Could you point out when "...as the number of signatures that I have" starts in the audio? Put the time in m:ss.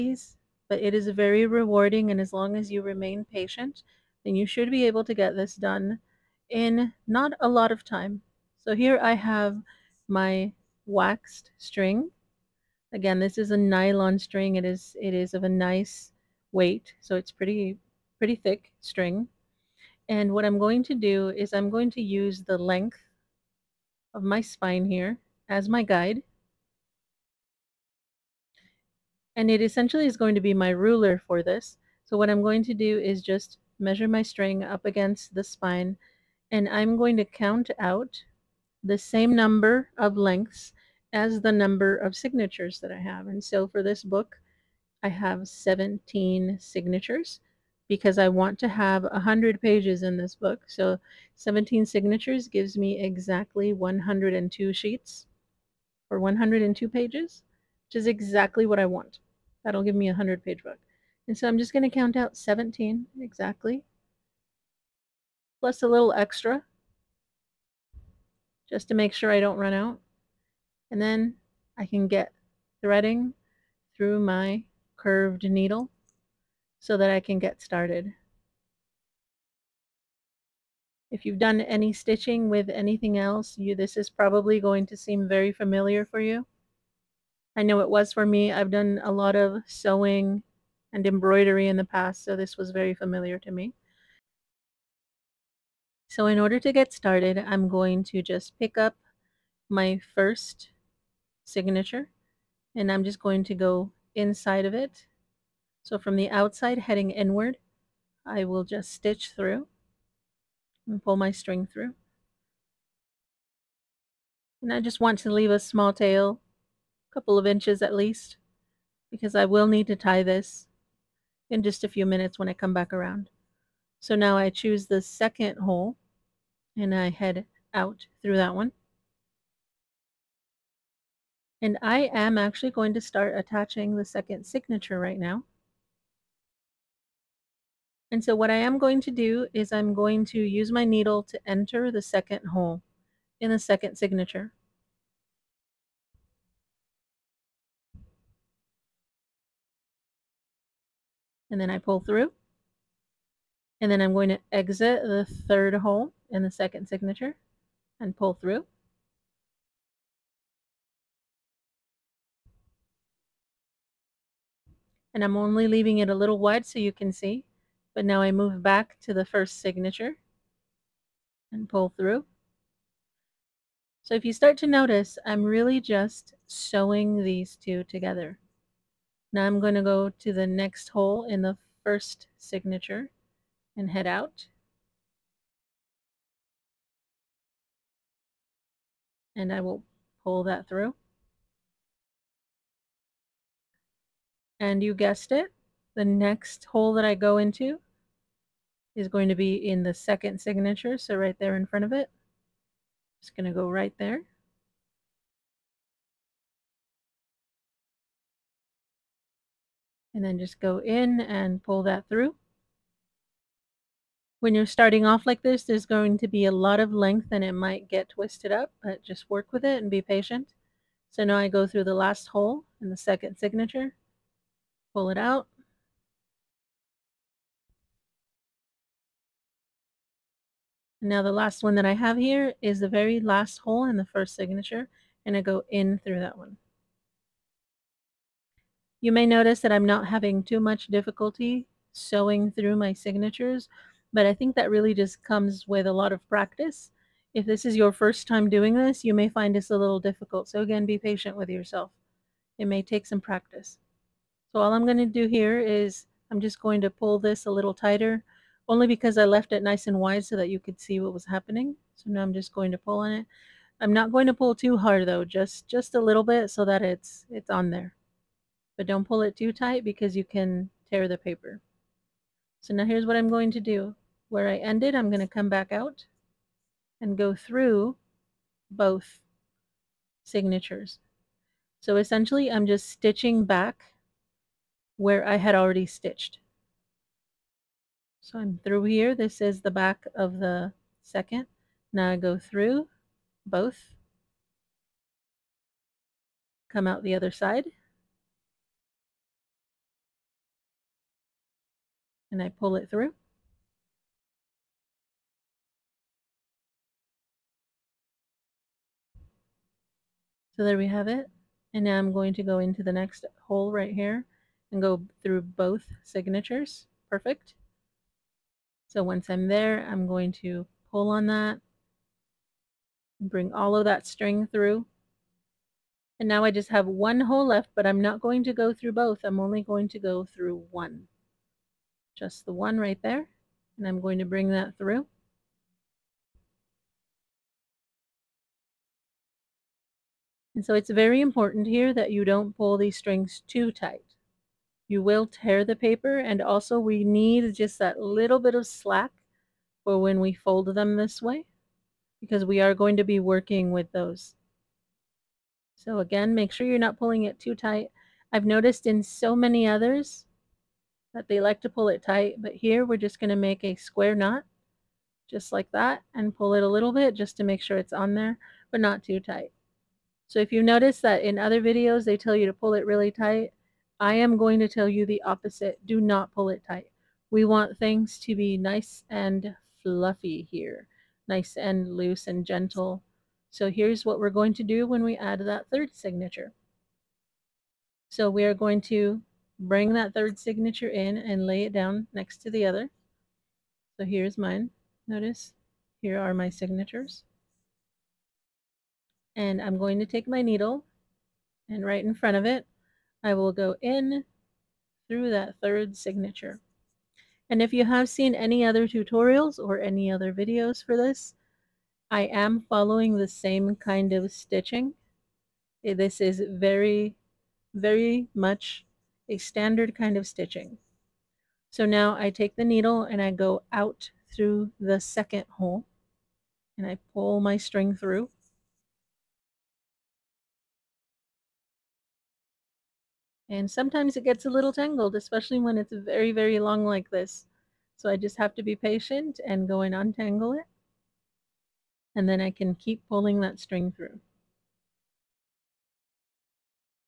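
0:41.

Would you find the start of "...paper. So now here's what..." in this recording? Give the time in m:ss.
4:31.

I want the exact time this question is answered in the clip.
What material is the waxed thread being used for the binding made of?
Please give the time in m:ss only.
0:13.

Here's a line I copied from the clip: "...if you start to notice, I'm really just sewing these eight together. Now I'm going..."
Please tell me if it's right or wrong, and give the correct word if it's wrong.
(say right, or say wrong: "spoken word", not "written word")
wrong: "two", not "eight".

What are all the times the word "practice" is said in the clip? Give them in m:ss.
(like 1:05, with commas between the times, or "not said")
4:06, 4:13.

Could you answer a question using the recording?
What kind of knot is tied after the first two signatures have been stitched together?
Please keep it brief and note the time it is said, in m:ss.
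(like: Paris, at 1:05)
square knot, at 6:03.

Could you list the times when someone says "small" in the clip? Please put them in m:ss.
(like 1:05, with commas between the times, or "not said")
1:55.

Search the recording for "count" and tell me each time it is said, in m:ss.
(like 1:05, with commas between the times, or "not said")
0:37, 1:01.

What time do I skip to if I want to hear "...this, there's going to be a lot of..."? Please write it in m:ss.
3:35.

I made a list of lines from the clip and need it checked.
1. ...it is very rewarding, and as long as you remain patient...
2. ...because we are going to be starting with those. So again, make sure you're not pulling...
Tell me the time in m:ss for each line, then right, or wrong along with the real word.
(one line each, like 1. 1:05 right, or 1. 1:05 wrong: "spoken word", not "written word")
1. 0:00 right
2. 5:52 wrong: "working", not "starting".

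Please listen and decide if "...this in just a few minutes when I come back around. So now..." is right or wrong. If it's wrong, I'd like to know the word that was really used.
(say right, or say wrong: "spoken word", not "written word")
right.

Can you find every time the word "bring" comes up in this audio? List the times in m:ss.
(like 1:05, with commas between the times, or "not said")
5:23, 5:34, 6:29.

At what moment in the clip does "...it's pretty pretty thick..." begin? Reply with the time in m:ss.
0:17.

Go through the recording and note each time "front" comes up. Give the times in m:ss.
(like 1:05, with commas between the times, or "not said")
3:21, 6:42.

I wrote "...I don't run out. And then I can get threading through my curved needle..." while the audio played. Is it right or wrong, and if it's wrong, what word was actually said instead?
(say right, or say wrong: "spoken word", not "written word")
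right.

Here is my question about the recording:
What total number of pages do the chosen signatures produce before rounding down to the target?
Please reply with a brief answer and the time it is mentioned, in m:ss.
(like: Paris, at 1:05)
102, at 0:56.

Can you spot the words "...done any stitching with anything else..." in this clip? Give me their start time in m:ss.
1:21.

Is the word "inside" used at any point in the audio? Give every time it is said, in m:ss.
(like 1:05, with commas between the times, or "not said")
1:44.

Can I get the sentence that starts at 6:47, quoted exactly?
And if you have seen any other tutorials or any other videos for this, I am following the same kind of stitching.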